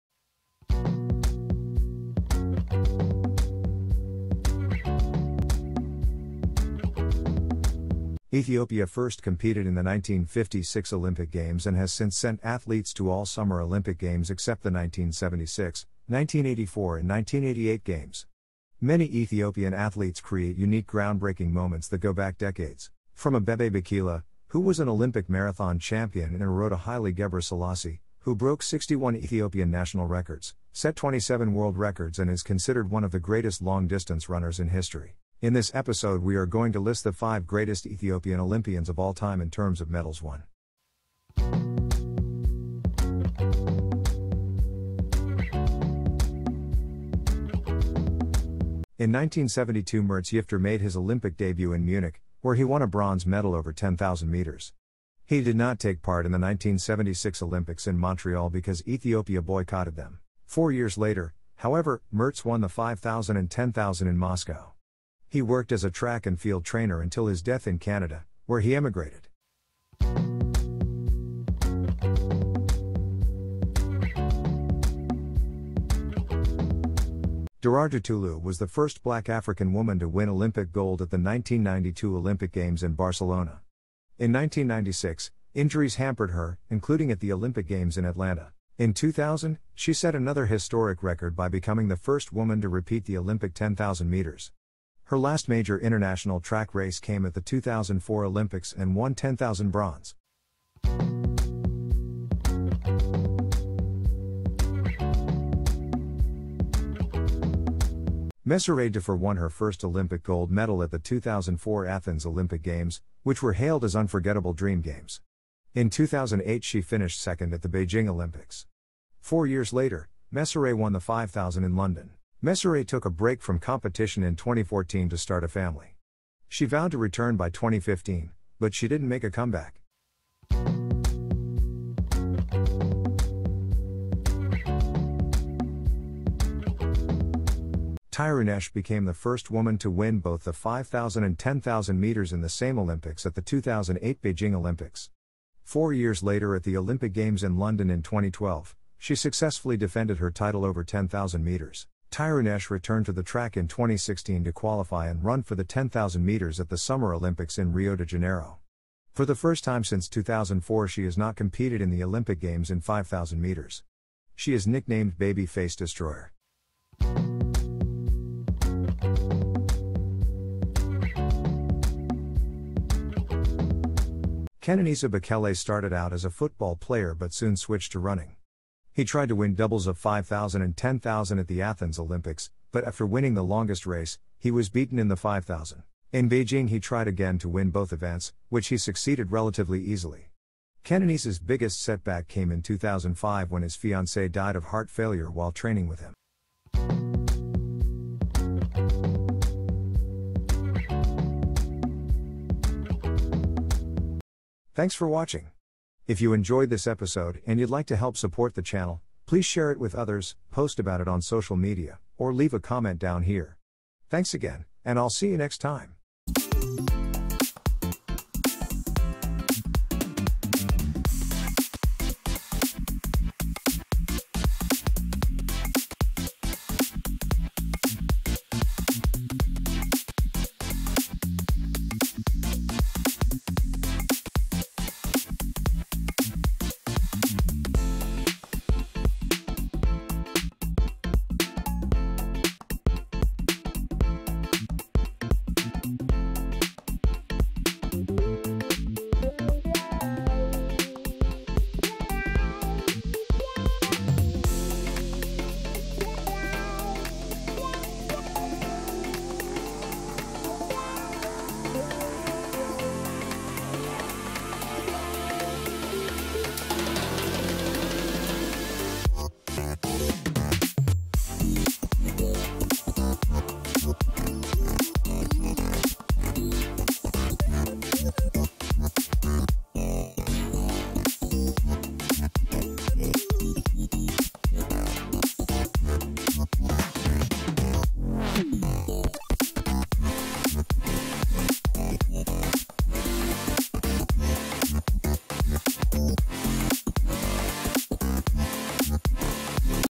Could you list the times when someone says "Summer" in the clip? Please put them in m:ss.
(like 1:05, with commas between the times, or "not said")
0:13, 2:36.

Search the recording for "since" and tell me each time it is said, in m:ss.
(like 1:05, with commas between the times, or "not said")
0:11, 2:39.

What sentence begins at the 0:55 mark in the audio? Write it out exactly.
He did not take part in the 1976 Olympics in Montreal because Ethiopia boycotted them.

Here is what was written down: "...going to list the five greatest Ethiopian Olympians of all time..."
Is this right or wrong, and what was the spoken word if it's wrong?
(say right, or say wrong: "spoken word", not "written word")
right.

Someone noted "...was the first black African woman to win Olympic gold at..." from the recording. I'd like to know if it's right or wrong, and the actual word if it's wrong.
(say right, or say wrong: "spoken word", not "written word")
right.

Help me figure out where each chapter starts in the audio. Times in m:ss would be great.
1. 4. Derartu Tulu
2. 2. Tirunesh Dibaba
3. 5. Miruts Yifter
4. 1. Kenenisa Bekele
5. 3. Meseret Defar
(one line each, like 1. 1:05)
1. 1:16
2. 2:14
3. 0:45
4. 2:47
5. 1:45.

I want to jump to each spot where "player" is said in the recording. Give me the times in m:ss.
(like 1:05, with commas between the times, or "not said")
2:56.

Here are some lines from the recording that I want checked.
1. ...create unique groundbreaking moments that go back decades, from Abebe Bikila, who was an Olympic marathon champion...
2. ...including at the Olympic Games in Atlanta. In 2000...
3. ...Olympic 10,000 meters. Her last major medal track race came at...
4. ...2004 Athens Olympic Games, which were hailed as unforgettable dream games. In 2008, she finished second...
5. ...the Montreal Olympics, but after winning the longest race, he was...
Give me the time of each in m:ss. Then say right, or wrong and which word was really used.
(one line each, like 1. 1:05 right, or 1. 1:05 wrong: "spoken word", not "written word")
1. 0:20 right
2. 1:26 right
3. 1:33 wrong: "international", not "medal"
4. 1:50 right
5. 3:01 wrong: "Athens", not "Montreal".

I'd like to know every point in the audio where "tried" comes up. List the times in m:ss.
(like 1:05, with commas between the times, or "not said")
2:59, 3:06.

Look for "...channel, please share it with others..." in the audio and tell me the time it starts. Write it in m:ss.
3:28.